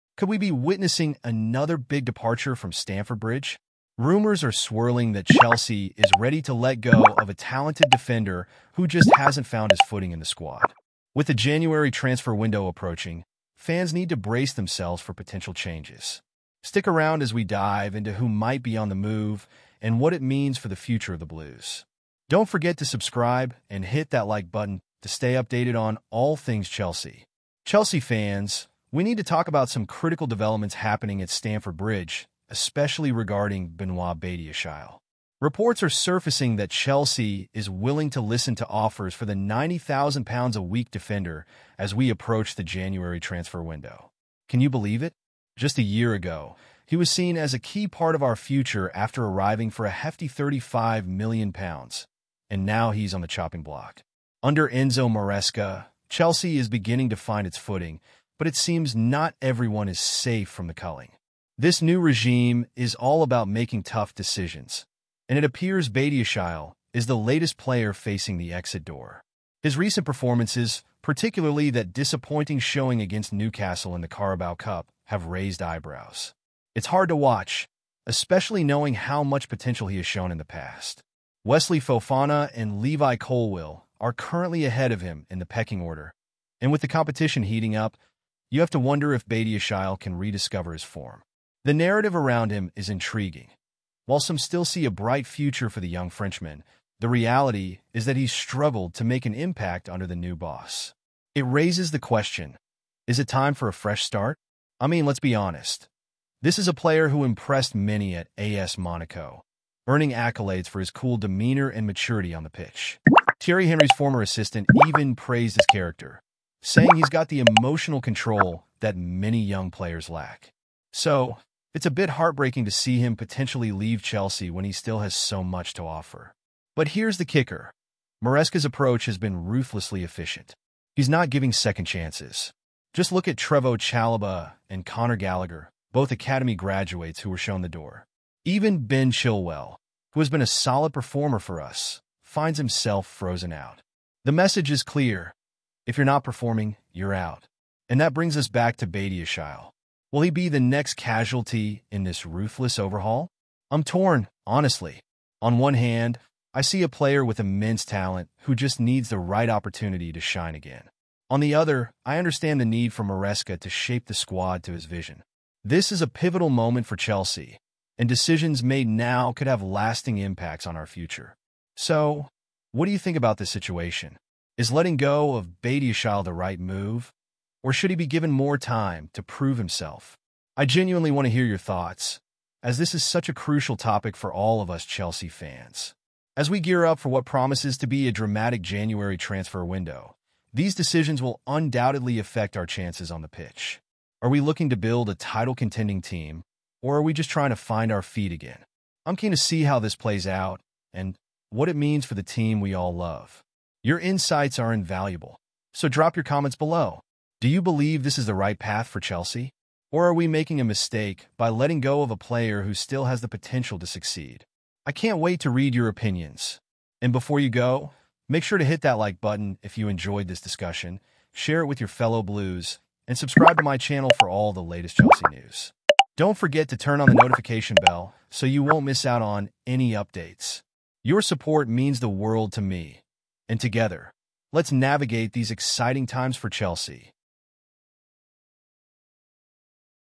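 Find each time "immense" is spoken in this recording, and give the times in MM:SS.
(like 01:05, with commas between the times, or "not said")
02:37.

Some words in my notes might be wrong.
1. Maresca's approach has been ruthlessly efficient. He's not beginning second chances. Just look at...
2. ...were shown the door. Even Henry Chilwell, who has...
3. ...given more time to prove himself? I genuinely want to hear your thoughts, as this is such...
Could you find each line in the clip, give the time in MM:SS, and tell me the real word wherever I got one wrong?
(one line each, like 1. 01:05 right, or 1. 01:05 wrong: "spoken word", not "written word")
1. 02:08 wrong: "giving", not "beginning"
2. 02:17 wrong: "Ben", not "Henry"
3. 02:58 right.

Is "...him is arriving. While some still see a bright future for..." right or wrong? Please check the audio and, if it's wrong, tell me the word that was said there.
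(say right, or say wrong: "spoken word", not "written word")
wrong: "intriguing", not "arriving".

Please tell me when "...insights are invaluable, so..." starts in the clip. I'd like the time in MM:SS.
03:23.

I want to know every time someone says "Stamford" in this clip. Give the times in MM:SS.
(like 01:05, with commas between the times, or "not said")
00:02, 00:31.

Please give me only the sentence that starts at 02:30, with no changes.
Will he be the next casualty in this ruthless overhaul?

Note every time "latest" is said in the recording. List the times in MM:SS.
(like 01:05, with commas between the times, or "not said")
01:07, 03:44.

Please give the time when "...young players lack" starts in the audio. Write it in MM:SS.
01:59.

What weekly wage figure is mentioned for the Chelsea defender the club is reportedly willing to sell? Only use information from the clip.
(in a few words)
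£90,000.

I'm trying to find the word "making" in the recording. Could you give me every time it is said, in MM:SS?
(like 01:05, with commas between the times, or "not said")
01:03, 03:30.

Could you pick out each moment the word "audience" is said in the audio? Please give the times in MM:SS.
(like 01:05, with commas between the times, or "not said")
not said.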